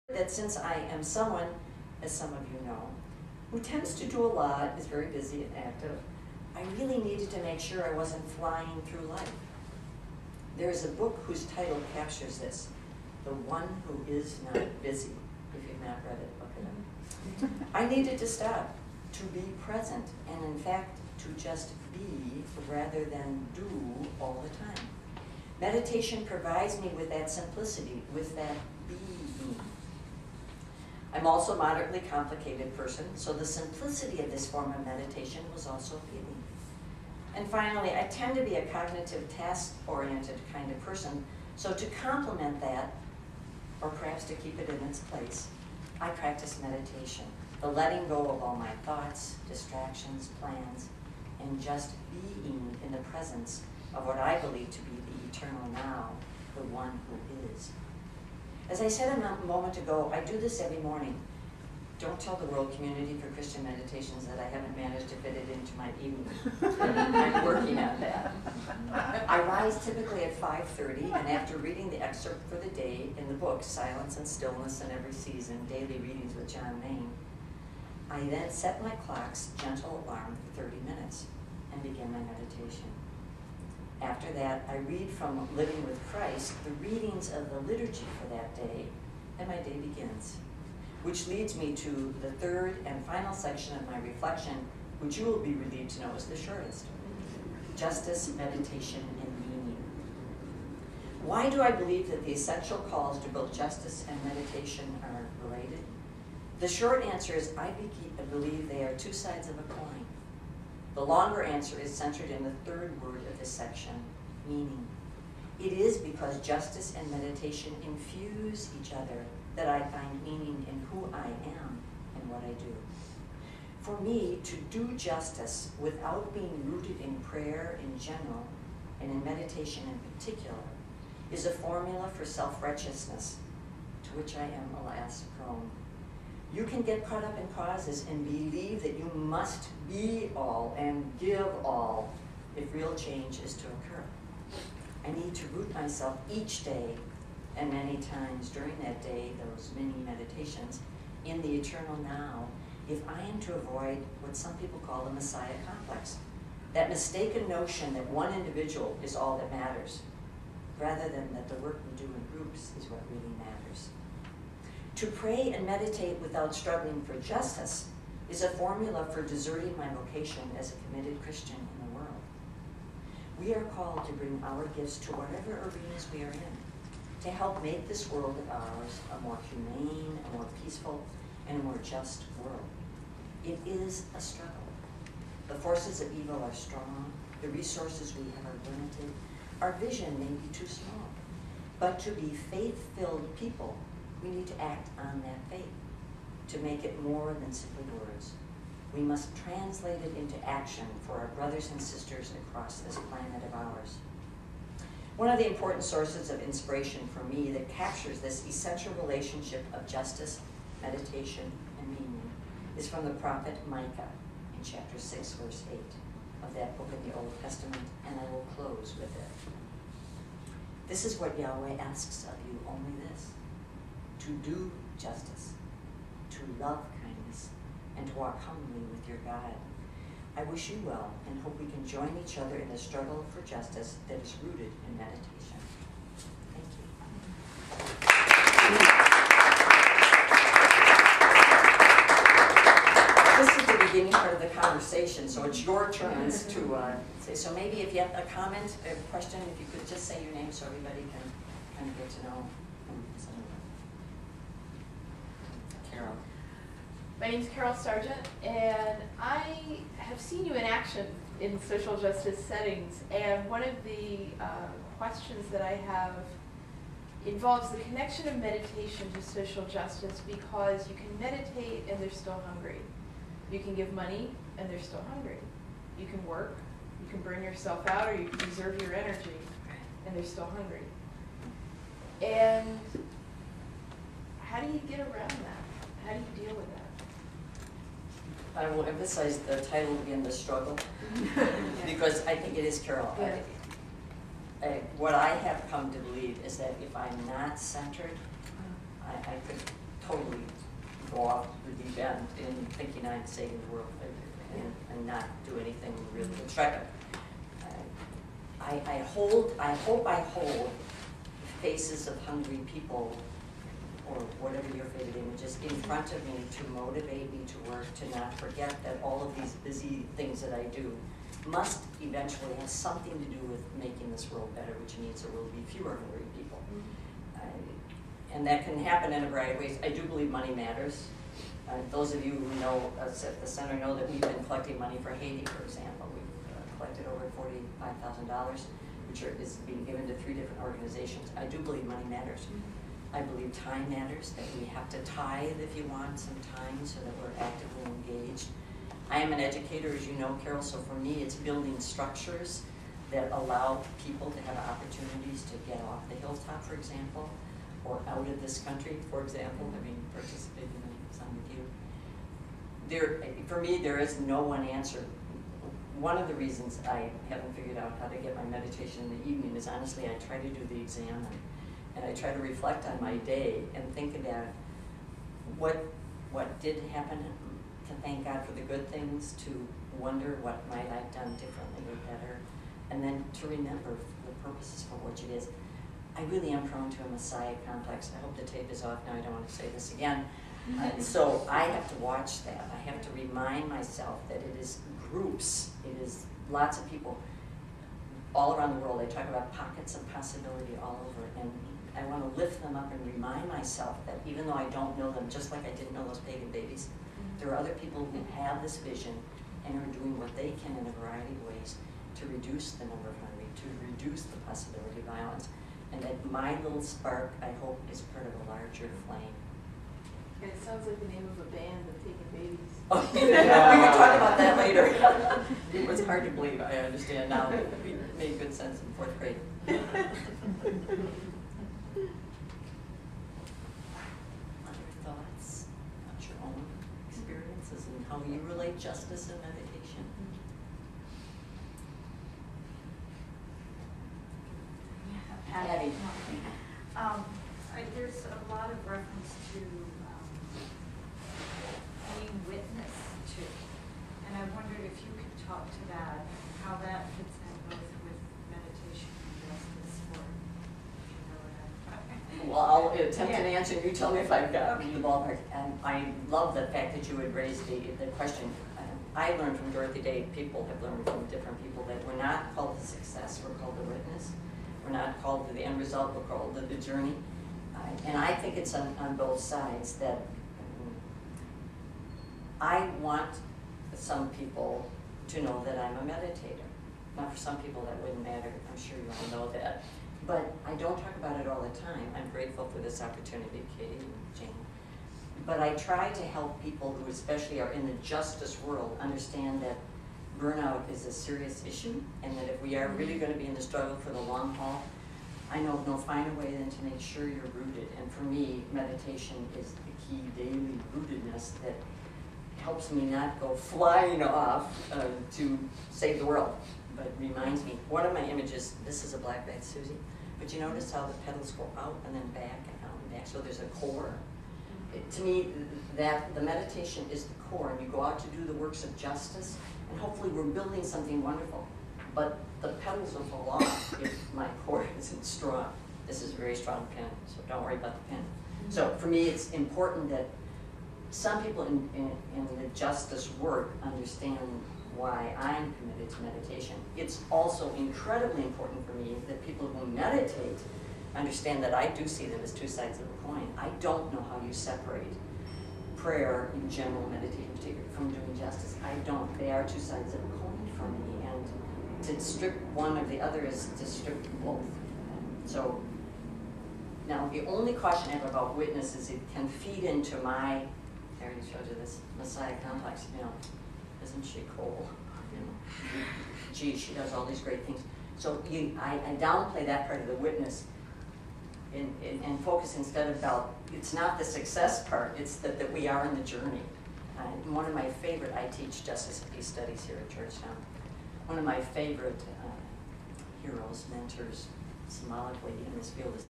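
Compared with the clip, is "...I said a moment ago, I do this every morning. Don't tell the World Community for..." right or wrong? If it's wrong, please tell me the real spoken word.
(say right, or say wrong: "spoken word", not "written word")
right.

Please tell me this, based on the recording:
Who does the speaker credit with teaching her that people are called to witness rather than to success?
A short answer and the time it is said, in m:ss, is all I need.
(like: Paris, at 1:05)
Dorothy Day, at 7:49.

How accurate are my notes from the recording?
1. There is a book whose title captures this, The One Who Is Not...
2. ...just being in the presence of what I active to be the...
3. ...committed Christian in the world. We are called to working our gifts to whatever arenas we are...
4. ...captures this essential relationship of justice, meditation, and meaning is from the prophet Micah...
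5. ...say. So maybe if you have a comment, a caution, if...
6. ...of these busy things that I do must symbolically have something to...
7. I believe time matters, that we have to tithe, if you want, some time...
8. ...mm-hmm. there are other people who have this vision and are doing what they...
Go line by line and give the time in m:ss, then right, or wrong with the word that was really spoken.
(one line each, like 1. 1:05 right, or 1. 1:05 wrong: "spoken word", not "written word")
1. 0:10 right
2. 0:51 wrong: "believe", not "active"
3. 2:50 wrong: "bring", not "working"
4. 3:27 right
5. 4:07 wrong: "question", not "caution"
6. 5:19 wrong: "eventually", not "symbolically"
7. 5:43 right
8. 6:46 right.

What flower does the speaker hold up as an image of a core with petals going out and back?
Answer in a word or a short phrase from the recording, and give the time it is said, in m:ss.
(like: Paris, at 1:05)
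black-eyed Susie, at 8:39.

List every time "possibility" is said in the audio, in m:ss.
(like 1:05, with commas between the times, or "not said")
6:40, 6:54.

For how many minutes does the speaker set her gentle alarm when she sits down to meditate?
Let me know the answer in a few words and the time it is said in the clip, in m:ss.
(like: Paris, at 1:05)
30, at 1:20.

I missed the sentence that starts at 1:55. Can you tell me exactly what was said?
It is because justice and meditation infuse each other that I find meaning in who I am and what I do.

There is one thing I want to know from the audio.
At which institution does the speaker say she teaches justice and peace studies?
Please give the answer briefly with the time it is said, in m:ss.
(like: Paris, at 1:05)
Georgetown, at 9:50.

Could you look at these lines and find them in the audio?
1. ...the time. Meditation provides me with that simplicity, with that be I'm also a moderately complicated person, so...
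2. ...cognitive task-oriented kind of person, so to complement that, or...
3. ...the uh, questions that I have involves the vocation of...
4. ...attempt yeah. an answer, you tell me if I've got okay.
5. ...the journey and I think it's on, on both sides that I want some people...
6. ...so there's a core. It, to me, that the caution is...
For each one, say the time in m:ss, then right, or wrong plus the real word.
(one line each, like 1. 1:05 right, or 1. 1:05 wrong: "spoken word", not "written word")
1. 0:24 right
2. 0:38 right
3. 4:23 wrong: "connection", not "vocation"
4. 7:43 right
5. 7:56 right
6. 8:43 wrong: "meditation", not "caution".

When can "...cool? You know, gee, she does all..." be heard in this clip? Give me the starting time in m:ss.
9:34.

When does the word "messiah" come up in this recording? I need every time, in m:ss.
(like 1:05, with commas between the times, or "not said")
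2:35, 6:27, 9:32.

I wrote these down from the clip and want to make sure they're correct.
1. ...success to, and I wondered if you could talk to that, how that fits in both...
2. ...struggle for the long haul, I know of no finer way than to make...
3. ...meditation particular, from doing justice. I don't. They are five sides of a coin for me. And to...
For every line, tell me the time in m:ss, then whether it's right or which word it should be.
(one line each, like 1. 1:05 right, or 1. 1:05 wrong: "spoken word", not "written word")
1. 7:32 wrong: "witness", not "success"
2. 8:23 right
3. 9:17 wrong: "two", not "five".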